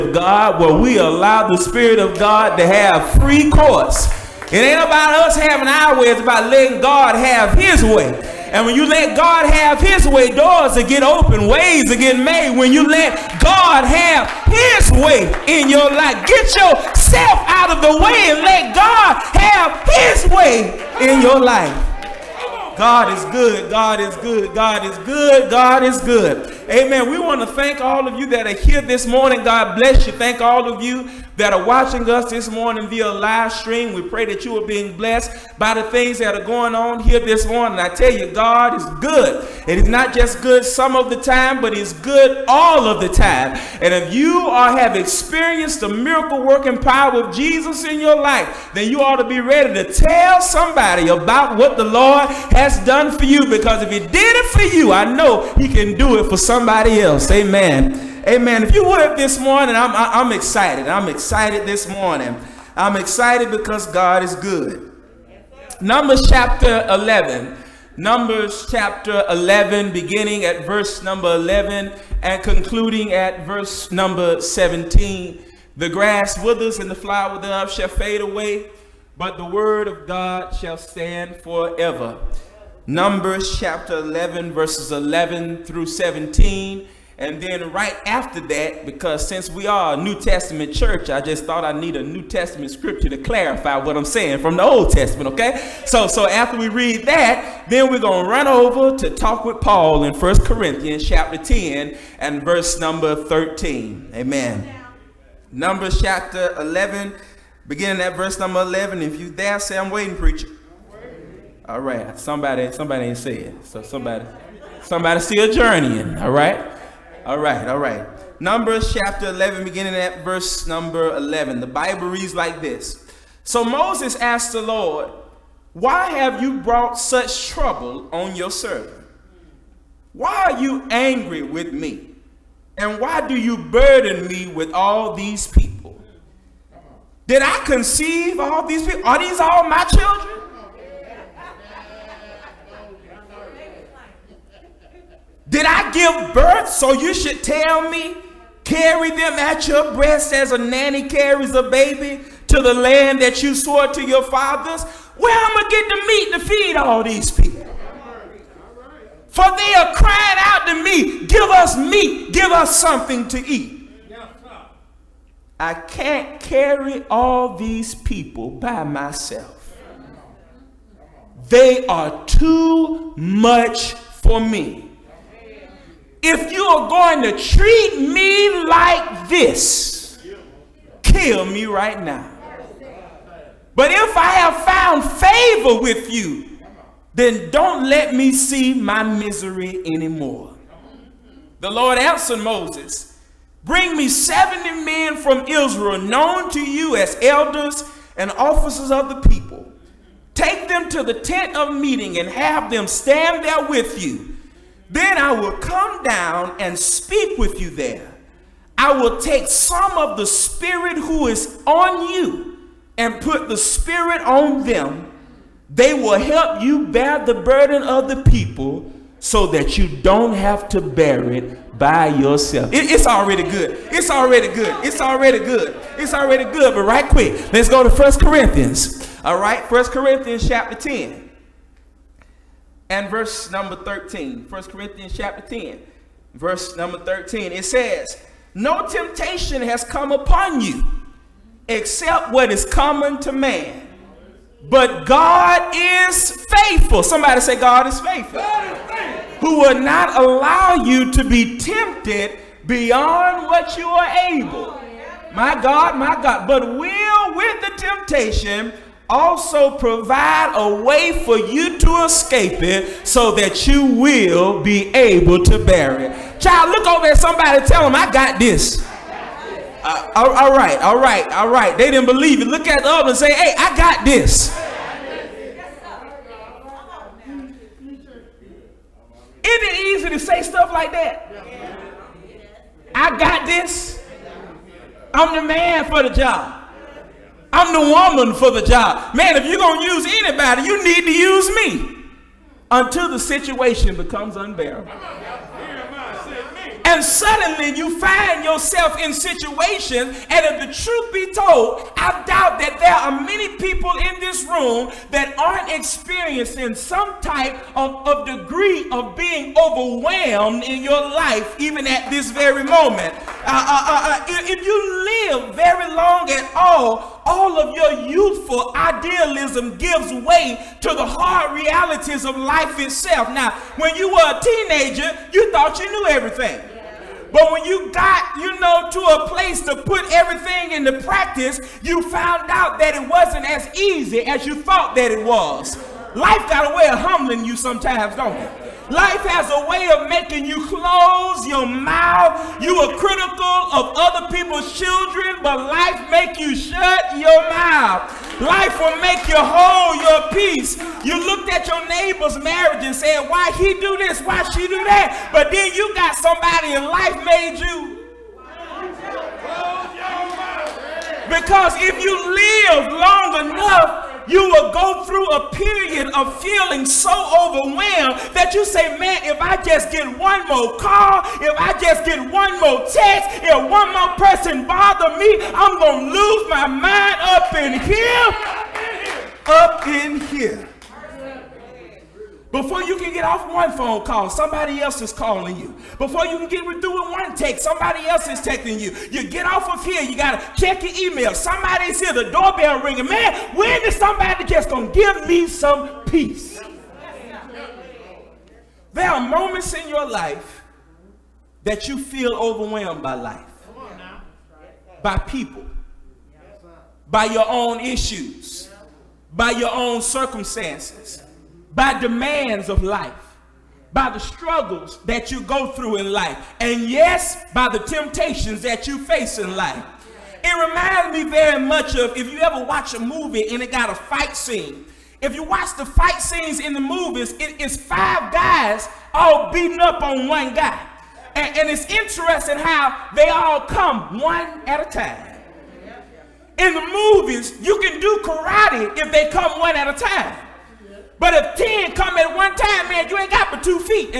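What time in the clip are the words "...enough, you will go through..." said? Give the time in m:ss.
6:03.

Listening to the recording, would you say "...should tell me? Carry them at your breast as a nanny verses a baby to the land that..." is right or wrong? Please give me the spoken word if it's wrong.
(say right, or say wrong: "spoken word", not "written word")
wrong: "carries", not "verses".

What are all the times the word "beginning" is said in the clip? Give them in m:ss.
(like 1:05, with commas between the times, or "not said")
1:09, 1:47, 1:59.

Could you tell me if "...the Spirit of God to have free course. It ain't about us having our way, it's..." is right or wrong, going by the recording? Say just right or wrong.
right.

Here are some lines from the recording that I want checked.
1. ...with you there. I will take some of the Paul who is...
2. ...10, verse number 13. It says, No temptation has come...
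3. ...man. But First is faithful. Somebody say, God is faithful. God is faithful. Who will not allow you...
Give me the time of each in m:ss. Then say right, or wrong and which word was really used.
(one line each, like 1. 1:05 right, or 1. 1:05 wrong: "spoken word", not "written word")
1. 3:27 wrong: "Spirit", not "Paul"
2. 3:55 right
3. 4:03 wrong: "God", not "First".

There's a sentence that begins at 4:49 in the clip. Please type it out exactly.
Man, if you're going to use anybody, you need to use me until the situation becomes unbearable.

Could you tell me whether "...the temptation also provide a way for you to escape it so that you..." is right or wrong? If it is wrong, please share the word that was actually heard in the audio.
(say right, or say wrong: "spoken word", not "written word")
right.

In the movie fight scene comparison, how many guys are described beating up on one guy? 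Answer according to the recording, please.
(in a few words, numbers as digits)
5.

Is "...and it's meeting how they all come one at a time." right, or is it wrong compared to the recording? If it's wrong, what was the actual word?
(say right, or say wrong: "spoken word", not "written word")
wrong: "interesting", not "meeting".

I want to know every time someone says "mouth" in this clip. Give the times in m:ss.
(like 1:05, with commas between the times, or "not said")
5:41, 5:47.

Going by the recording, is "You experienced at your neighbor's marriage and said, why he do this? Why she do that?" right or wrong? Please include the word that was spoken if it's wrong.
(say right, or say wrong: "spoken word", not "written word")
wrong: "looked", not "experienced".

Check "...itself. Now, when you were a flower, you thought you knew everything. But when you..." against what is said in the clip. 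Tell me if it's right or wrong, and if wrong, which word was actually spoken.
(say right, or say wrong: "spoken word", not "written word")
wrong: "teenager", not "flower".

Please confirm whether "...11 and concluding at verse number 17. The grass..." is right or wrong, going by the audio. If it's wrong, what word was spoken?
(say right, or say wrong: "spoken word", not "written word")
right.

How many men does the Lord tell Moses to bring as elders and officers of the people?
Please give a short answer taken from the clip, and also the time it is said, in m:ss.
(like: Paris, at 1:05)
70, at 3:14.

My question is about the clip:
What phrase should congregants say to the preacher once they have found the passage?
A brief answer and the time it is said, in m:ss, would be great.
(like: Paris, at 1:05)
I'm waiting, preacher, at 1:49.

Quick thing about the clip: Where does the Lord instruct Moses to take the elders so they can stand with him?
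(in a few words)
The tent of meeting.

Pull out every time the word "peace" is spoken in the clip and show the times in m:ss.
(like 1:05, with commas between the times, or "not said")
5:50, 6:36.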